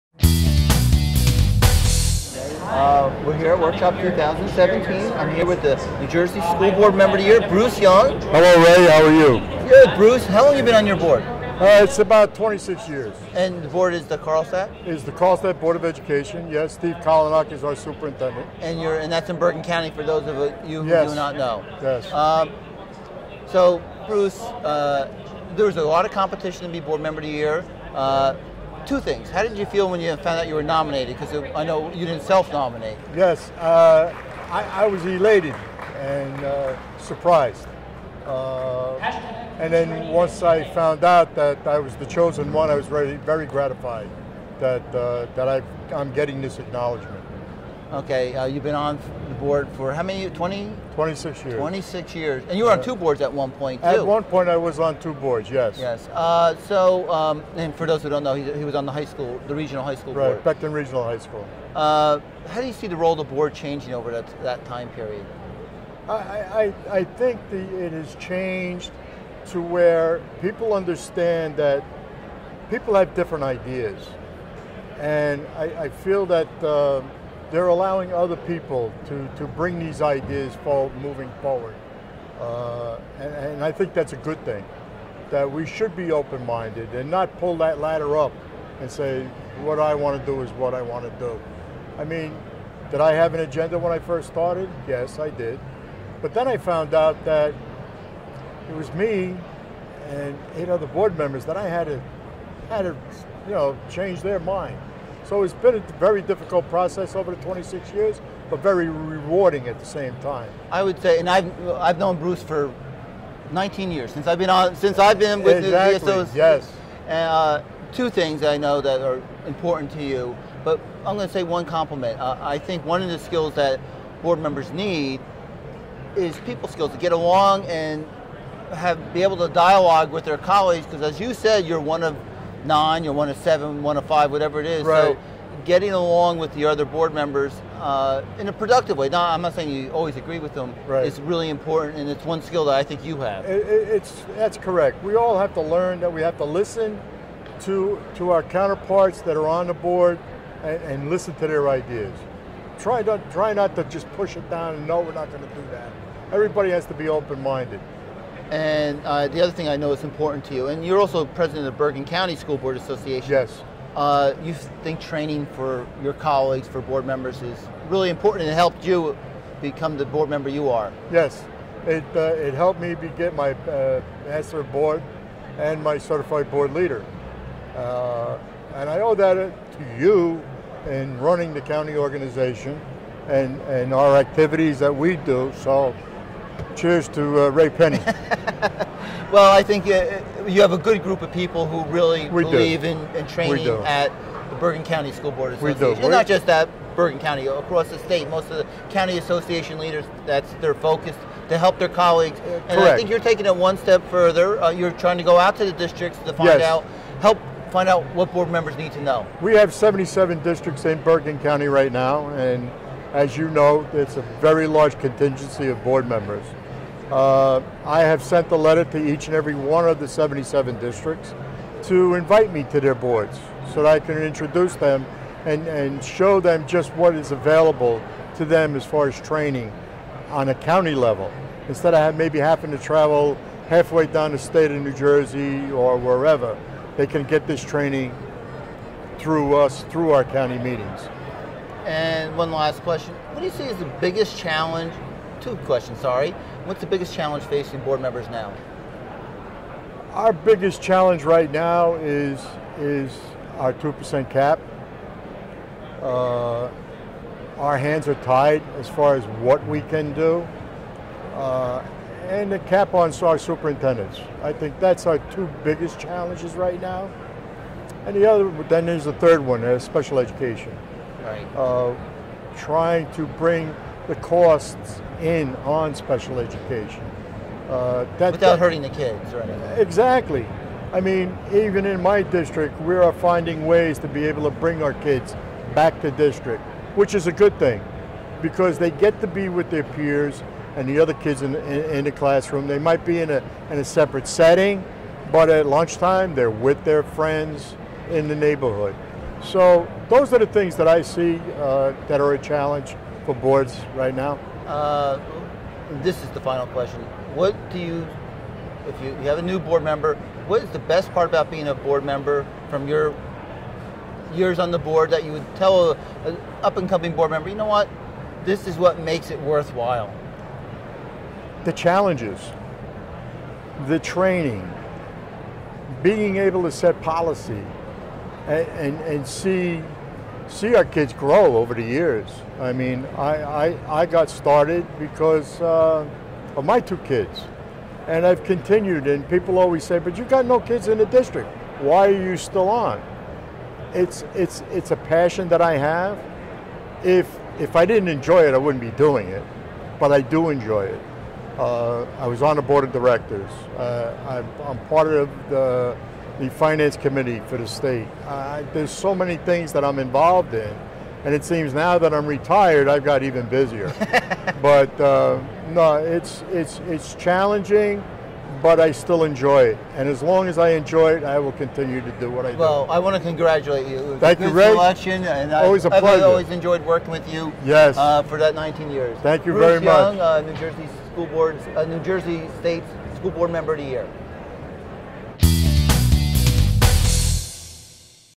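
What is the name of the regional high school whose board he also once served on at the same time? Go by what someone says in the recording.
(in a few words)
Becton Regional High School.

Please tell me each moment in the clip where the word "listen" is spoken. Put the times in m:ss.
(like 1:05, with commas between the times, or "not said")
2:26, 2:31.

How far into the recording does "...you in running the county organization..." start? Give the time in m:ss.
2:59.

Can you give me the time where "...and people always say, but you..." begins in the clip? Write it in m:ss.
5:39.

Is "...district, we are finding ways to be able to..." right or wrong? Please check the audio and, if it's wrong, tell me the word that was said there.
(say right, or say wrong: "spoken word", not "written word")
right.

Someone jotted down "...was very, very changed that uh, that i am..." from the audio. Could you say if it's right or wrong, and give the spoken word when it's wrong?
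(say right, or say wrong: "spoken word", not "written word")
wrong: "gratified", not "changed".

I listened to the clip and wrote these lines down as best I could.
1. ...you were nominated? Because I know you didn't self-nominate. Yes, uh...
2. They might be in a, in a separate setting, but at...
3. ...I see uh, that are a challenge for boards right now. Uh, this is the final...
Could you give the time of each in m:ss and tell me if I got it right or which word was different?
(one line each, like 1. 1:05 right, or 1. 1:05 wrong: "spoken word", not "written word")
1. 0:30 right
2. 4:52 right
3. 5:00 right.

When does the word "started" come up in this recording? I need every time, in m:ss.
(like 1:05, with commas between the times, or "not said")
1:34, 5:34.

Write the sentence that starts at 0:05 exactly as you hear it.
I'm here with the New Jersey School Board Member of the Year, Bruce Young.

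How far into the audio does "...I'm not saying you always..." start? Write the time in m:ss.
2:19.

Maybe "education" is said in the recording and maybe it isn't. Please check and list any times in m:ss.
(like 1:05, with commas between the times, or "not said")
0:15, 4:30, 4:36.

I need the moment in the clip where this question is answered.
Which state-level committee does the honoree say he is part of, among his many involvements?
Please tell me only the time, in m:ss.
5:56.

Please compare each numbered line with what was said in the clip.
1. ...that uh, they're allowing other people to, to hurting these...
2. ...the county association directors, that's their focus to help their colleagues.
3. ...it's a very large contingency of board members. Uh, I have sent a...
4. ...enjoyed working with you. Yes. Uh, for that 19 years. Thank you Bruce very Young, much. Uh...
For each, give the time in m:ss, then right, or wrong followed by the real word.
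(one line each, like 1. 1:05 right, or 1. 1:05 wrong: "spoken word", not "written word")
1. 1:16 wrong: "bring", not "hurting"
2. 3:18 wrong: "leaders", not "directors"
3. 3:33 right
4. 6:16 right.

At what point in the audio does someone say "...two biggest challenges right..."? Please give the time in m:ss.
4:25.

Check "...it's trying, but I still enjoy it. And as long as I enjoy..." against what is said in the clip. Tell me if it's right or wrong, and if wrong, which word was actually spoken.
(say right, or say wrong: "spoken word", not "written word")
wrong: "challenging", not "trying".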